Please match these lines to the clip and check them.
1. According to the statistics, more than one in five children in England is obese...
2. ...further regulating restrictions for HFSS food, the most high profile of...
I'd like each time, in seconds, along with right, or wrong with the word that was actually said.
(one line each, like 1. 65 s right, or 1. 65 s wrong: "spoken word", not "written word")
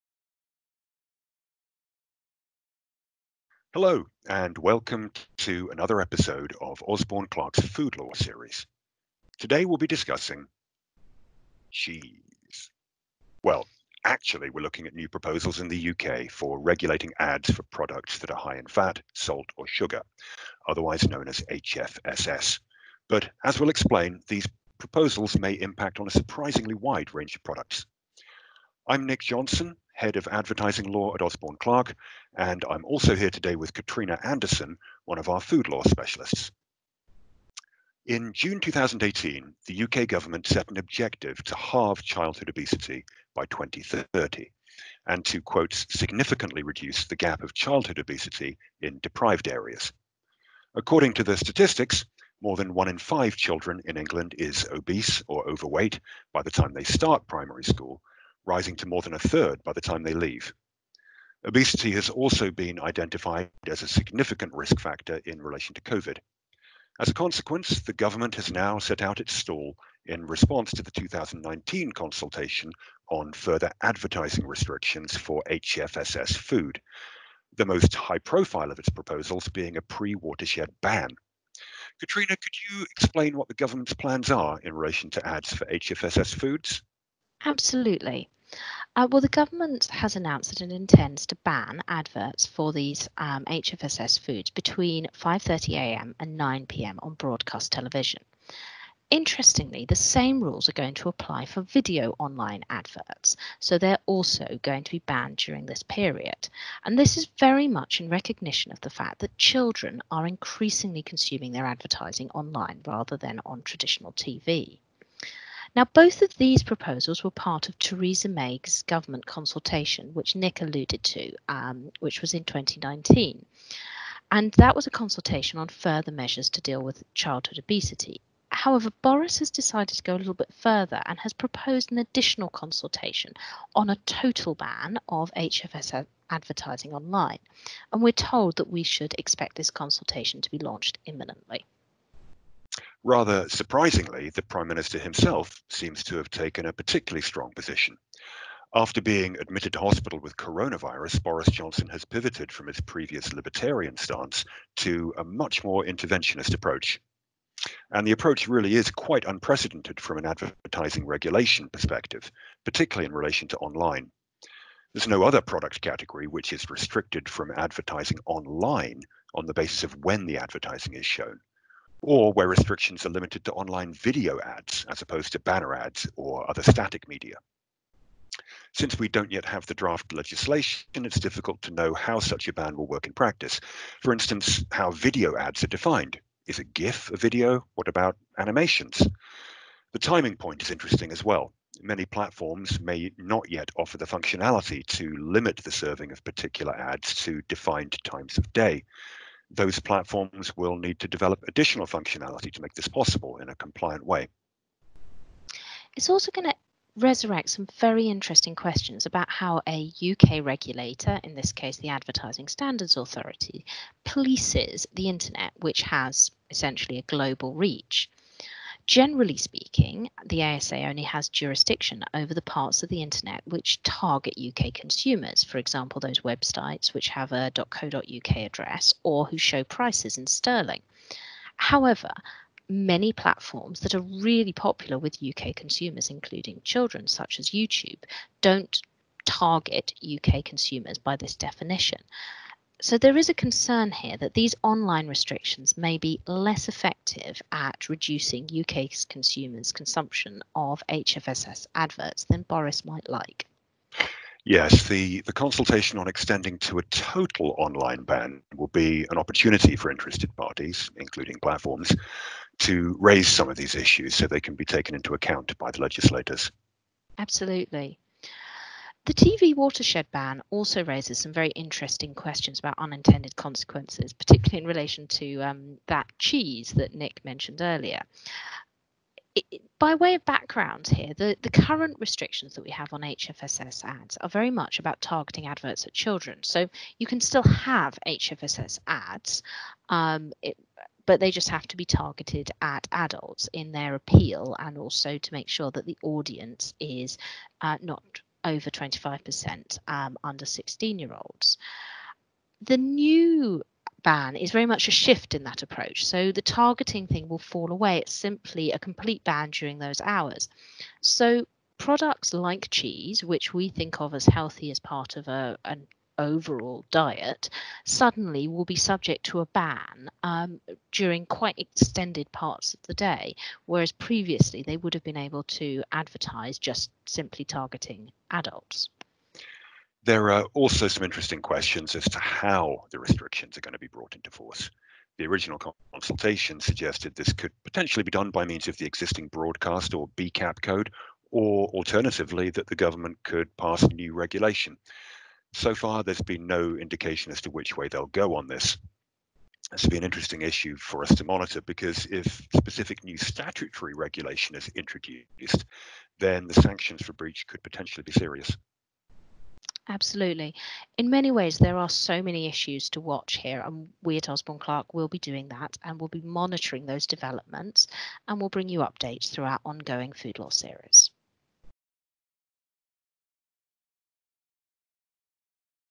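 1. 50 s right
2. 73 s wrong: "advertising", not "regulating".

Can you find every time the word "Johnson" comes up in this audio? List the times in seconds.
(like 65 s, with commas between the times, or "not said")
29 s, 151 s.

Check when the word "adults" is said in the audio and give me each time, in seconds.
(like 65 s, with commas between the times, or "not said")
292 s, 328 s.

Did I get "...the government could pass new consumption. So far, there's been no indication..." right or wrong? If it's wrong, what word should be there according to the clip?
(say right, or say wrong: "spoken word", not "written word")
wrong: "regulation", not "consumption".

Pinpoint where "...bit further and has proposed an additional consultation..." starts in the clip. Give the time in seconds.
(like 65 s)
130 s.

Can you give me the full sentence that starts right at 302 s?
The new ban is very much a shift in that approach.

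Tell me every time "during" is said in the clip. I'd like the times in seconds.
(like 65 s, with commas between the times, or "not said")
105 s, 309 s, 320 s.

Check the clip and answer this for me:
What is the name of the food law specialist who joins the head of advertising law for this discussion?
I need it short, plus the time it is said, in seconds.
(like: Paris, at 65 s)
Katrina Anderson, at 33 s.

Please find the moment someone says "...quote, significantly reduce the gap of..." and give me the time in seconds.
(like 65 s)
45 s.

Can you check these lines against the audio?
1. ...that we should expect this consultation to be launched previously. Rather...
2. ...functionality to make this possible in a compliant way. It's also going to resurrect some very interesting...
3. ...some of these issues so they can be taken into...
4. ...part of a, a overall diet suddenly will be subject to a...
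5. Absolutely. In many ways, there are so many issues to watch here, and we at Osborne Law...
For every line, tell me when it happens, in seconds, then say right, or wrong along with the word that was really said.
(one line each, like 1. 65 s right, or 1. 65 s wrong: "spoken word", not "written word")
1. 138 s wrong: "imminently", not "previously"
2. 201 s right
3. 263 s right
4. 314 s right
5. 359 s wrong: "Clarke", not "Law".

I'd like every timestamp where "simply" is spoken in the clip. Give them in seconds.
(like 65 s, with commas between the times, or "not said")
308 s, 327 s.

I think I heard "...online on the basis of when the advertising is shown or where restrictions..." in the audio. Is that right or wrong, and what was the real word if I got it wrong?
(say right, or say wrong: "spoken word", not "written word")
right.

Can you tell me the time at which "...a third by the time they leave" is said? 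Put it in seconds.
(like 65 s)
59 s.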